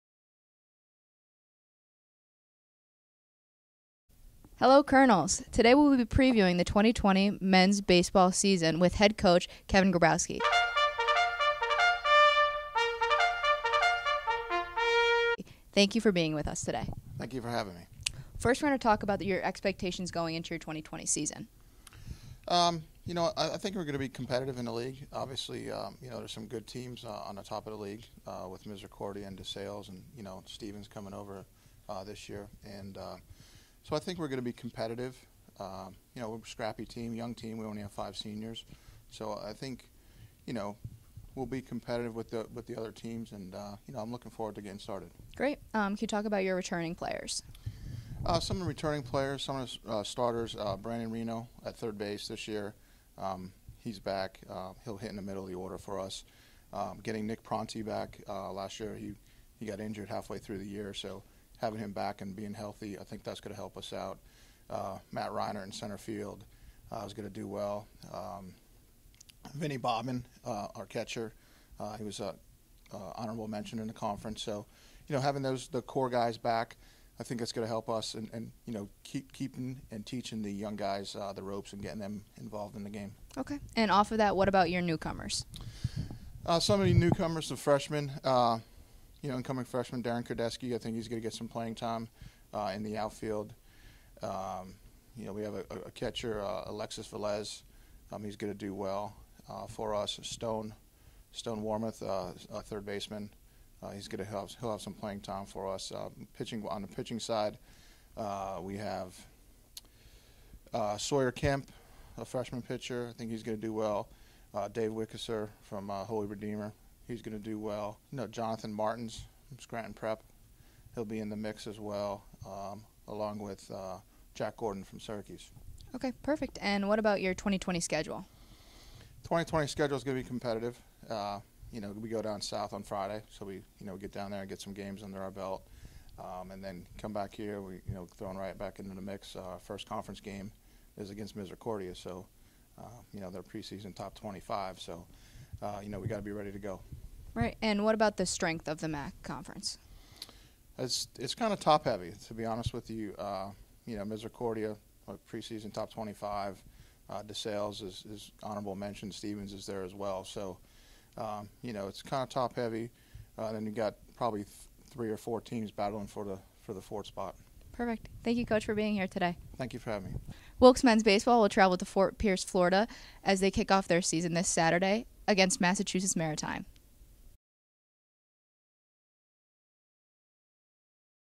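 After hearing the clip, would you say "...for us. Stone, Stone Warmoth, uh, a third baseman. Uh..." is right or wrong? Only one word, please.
right.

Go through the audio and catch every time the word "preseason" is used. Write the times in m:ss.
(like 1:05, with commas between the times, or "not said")
2:23, 2:35.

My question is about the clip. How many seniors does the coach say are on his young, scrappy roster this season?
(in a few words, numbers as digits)
5.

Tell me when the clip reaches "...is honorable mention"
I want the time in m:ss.
2:38.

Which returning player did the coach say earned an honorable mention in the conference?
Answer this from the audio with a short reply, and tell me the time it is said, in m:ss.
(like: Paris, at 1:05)
Vinny Bobbin, at 1:09.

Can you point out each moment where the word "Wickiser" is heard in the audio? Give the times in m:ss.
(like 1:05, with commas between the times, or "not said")
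1:54.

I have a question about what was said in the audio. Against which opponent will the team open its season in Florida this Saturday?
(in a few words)
Massachusetts Maritime.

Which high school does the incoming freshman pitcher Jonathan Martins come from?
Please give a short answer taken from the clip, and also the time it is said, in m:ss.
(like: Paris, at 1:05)
Scranton Prep, at 1:59.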